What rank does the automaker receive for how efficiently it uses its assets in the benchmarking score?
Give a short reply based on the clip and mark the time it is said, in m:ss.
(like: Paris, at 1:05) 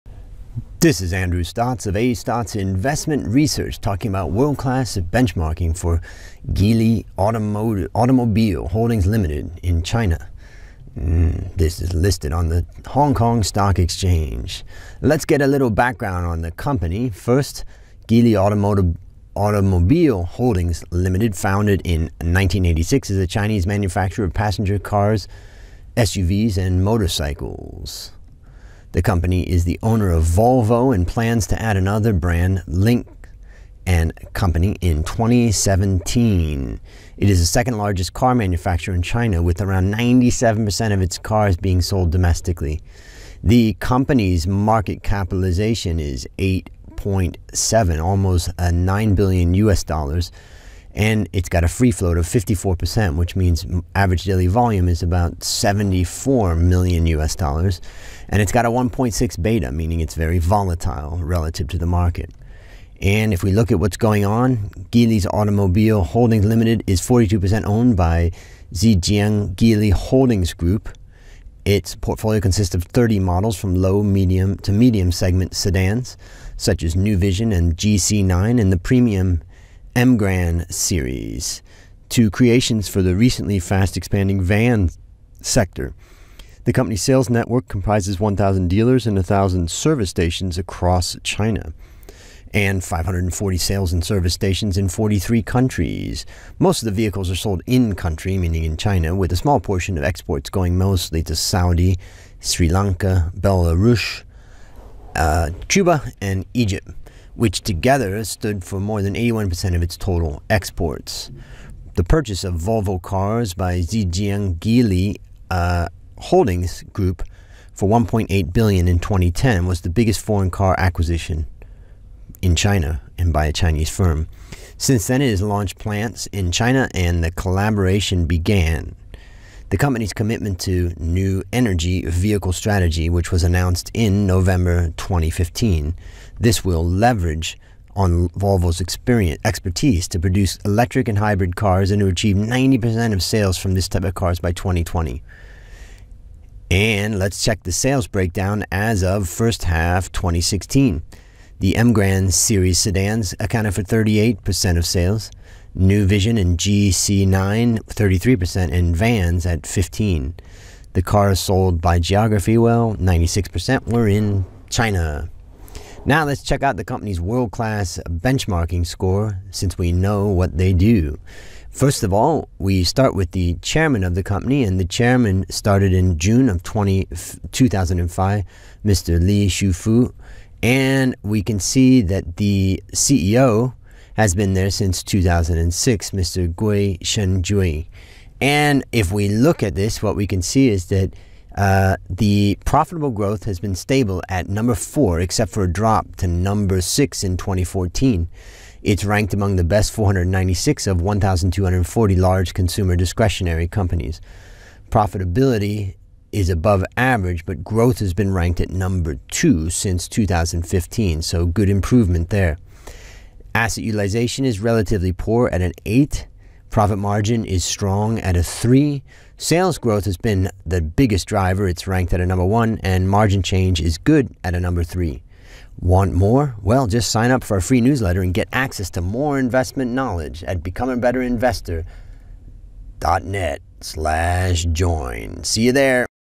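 8, at 3:35.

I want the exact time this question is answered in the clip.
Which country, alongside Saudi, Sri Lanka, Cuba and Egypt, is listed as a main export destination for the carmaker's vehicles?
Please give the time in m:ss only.
1:43.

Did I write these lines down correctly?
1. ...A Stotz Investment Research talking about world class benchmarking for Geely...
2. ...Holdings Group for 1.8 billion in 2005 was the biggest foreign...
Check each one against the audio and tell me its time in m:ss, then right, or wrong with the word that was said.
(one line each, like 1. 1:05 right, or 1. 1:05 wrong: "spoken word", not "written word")
1. 0:01 right
2. 1:56 wrong: "2010", not "2005".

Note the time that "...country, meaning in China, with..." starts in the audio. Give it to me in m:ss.
1:37.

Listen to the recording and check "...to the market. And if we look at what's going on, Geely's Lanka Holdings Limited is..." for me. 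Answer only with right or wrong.
wrong.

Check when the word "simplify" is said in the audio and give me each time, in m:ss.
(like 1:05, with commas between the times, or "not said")
not said.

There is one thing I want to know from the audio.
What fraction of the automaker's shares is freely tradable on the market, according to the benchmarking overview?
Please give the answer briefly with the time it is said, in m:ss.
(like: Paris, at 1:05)
54%, at 0:52.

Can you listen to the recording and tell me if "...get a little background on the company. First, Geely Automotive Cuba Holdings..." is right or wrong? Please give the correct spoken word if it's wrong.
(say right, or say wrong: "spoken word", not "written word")
wrong: "Automobile", not "Cuba".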